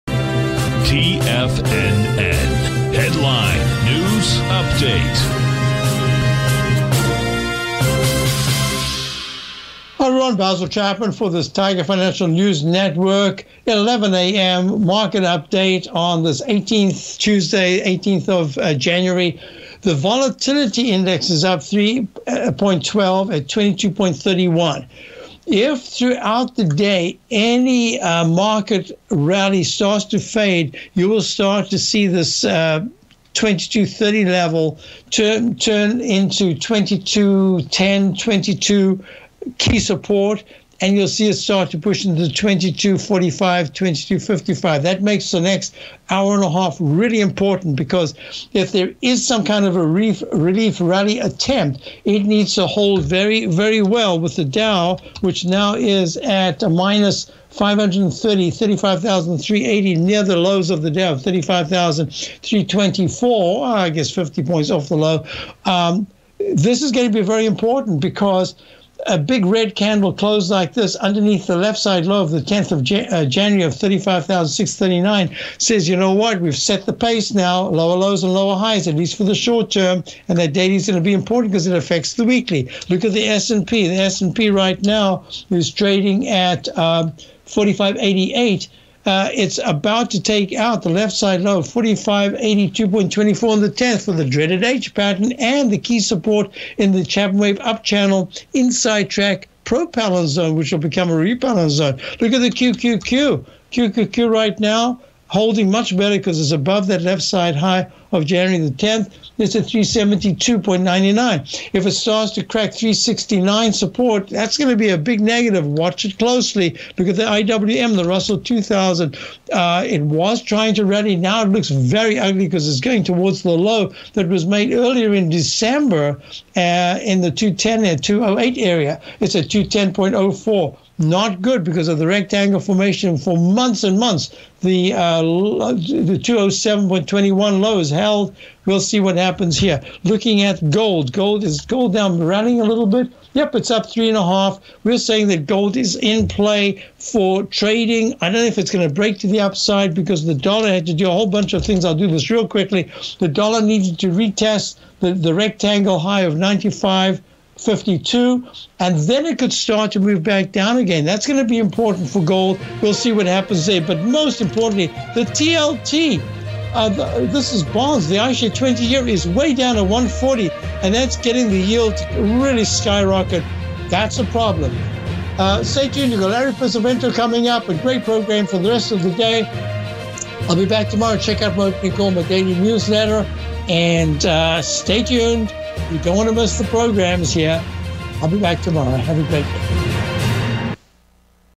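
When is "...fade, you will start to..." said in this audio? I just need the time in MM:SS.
00:30.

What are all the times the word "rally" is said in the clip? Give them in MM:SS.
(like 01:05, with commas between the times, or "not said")
00:29, 00:50, 02:00.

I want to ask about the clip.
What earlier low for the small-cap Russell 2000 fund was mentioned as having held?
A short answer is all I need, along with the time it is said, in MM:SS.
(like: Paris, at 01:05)
207.21, at 02:16.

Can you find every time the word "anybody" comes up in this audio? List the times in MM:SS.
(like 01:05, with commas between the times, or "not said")
not said.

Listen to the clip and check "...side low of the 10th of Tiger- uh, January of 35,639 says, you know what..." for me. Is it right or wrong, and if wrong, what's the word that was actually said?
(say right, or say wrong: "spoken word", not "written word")
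wrong: "Jan", not "Tiger".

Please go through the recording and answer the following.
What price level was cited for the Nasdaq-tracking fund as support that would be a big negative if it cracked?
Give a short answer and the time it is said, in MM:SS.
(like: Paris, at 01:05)
369, at 01:52.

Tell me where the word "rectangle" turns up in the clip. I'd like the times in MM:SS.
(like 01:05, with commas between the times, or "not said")
02:12, 02:35.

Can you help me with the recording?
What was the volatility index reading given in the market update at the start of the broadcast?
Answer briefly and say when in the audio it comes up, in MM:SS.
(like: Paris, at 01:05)
22.31, at 00:23.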